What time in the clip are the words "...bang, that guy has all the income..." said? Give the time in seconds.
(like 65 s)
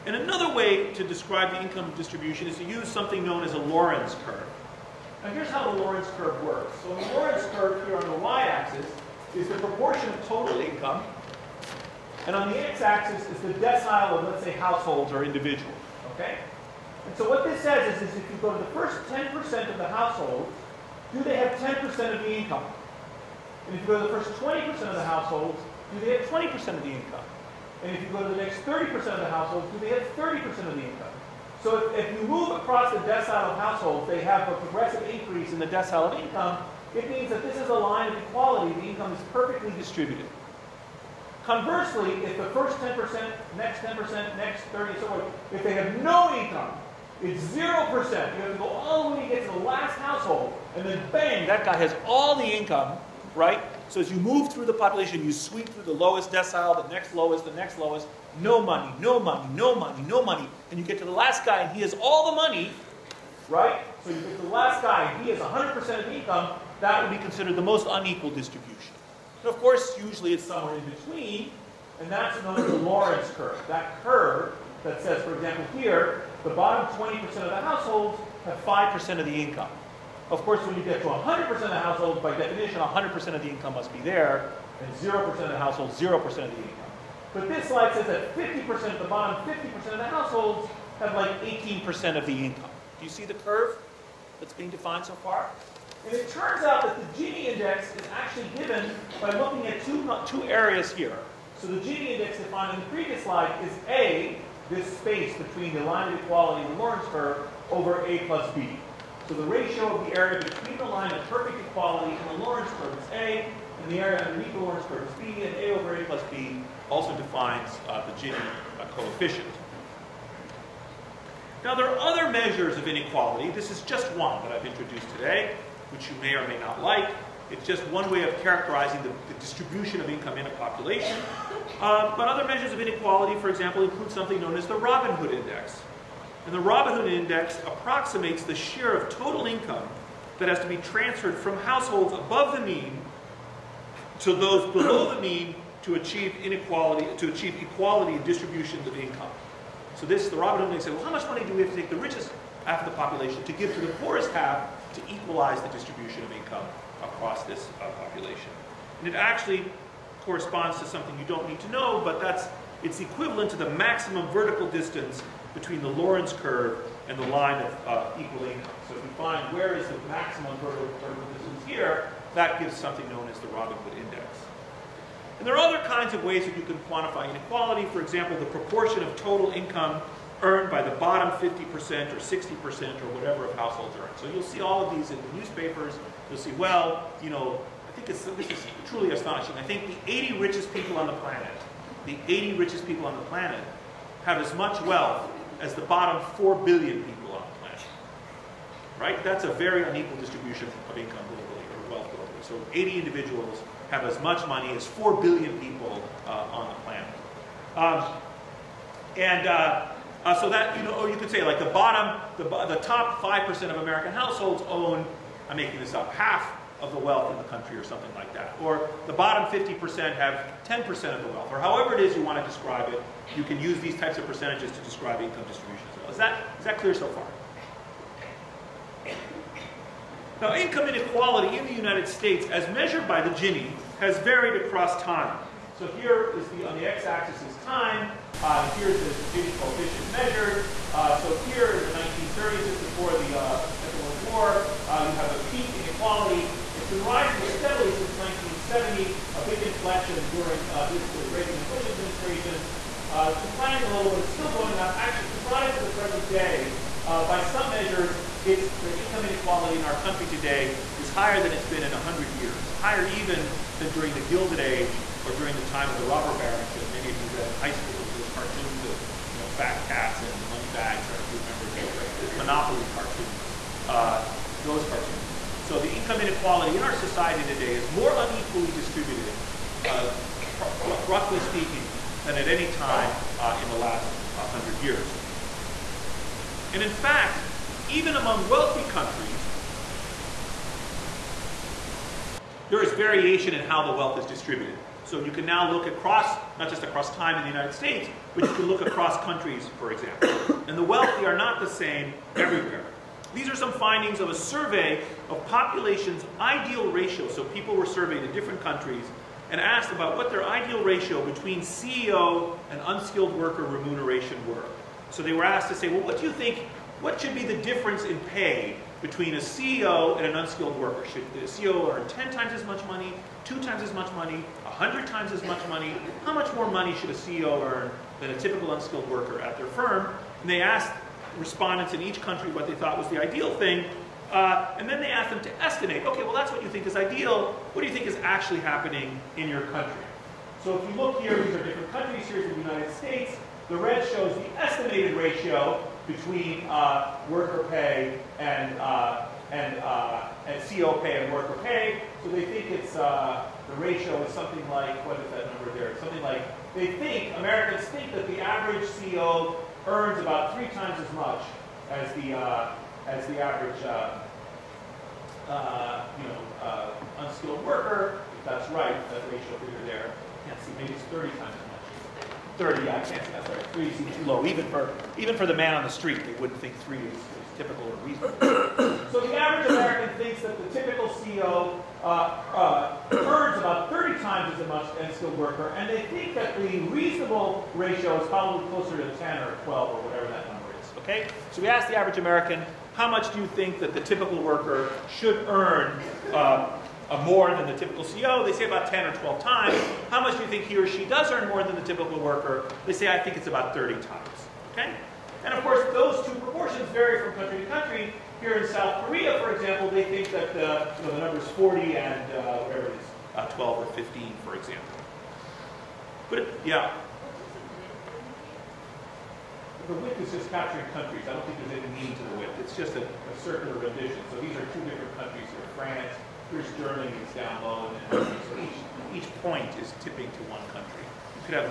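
51 s.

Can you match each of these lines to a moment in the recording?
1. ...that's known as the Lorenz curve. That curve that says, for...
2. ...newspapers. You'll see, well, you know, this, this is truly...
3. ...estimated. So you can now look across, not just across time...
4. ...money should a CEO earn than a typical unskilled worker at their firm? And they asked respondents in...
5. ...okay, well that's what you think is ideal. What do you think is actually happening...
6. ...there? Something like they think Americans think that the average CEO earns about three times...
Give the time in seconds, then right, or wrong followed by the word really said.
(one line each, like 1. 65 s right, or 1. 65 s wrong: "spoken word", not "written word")
1. 72 s right
2. 185 s right
3. 294 s wrong: "distributed", not "estimated"
4. 326 s right
5. 336 s right
6. 355 s right.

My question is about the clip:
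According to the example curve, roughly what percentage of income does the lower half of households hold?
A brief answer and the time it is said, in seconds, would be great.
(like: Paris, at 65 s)
18%, at 91 s.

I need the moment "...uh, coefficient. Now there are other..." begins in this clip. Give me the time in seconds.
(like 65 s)
118 s.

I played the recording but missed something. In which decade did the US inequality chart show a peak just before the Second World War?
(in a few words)
1930s.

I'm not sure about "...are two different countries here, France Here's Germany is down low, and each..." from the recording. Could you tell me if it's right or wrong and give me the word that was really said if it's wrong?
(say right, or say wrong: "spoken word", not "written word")
right.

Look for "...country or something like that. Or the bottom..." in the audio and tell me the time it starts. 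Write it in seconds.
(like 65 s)
217 s.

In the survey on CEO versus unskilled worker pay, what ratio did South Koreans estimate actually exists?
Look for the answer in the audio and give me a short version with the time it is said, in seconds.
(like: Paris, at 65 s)
40, at 411 s.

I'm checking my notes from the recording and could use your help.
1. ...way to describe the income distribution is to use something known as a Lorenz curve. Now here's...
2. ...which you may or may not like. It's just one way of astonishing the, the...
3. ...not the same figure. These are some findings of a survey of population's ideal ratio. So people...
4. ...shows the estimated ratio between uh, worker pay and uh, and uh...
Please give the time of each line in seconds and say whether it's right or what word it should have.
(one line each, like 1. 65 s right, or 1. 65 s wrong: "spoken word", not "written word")
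1. 0 s right
2. 125 s wrong: "characterizing", not "astonishing"
3. 301 s wrong: "everywhere", not "figure"
4. 344 s right.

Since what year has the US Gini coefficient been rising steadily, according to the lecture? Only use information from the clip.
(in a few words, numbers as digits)
1970.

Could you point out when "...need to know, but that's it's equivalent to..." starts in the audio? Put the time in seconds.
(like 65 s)
161 s.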